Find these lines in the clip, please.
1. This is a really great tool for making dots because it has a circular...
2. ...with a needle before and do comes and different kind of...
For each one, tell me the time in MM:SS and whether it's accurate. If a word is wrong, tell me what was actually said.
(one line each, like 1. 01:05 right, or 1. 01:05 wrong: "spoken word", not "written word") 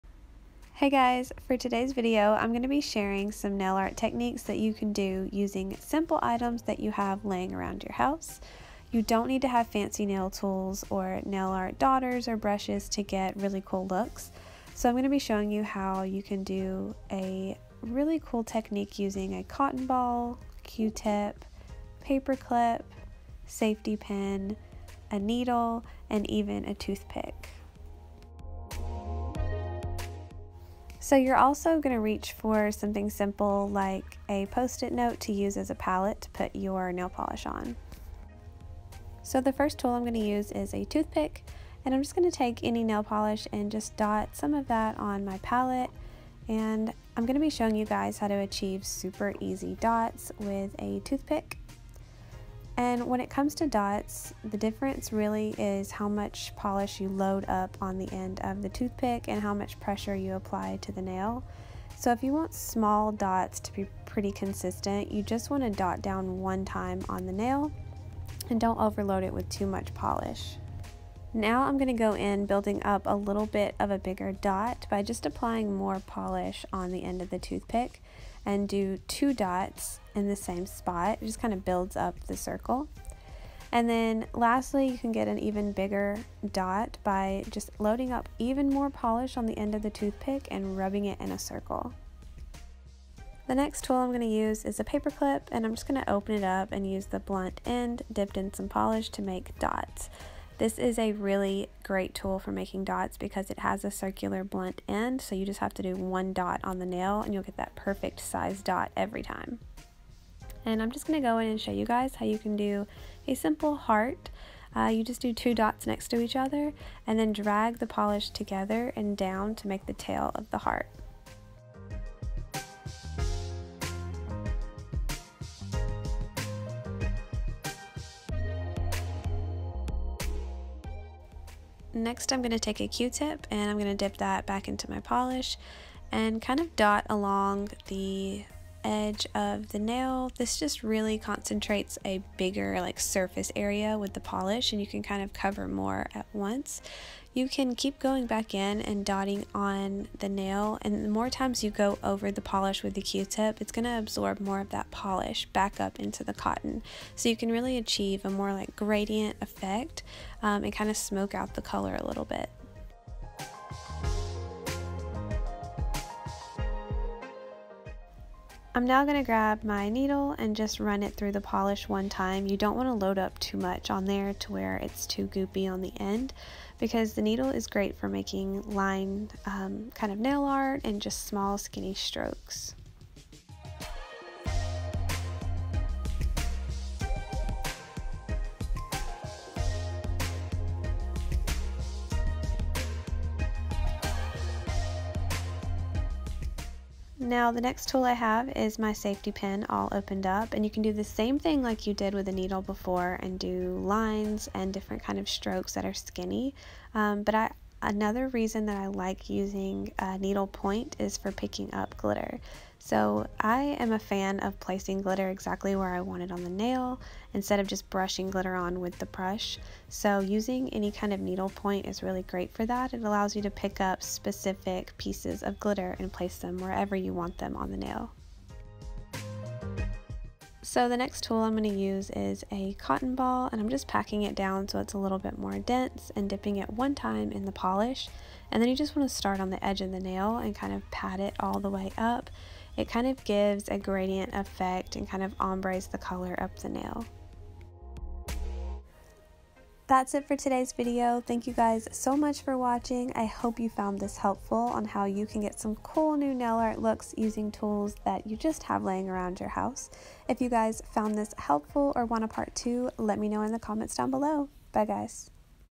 1. 01:40 right
2. 03:22 wrong: "lines", not "comes".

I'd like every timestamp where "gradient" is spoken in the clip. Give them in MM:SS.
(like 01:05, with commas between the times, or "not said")
02:38, 04:03.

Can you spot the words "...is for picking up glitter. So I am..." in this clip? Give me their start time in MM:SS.
03:30.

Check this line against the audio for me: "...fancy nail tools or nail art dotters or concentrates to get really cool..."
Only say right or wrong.
wrong.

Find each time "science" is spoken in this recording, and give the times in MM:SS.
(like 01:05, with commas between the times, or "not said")
not said.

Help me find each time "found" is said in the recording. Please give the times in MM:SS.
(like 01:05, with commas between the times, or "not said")
04:13, 04:20.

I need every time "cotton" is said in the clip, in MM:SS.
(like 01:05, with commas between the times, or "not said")
00:19, 02:36, 03:52.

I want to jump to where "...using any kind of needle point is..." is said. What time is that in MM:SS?
03:40.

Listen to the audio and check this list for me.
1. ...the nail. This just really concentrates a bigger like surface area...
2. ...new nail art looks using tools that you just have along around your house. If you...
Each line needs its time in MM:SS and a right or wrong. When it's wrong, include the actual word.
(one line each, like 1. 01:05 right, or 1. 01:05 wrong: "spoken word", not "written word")
1. 02:19 right
2. 04:16 wrong: "laying", not "along".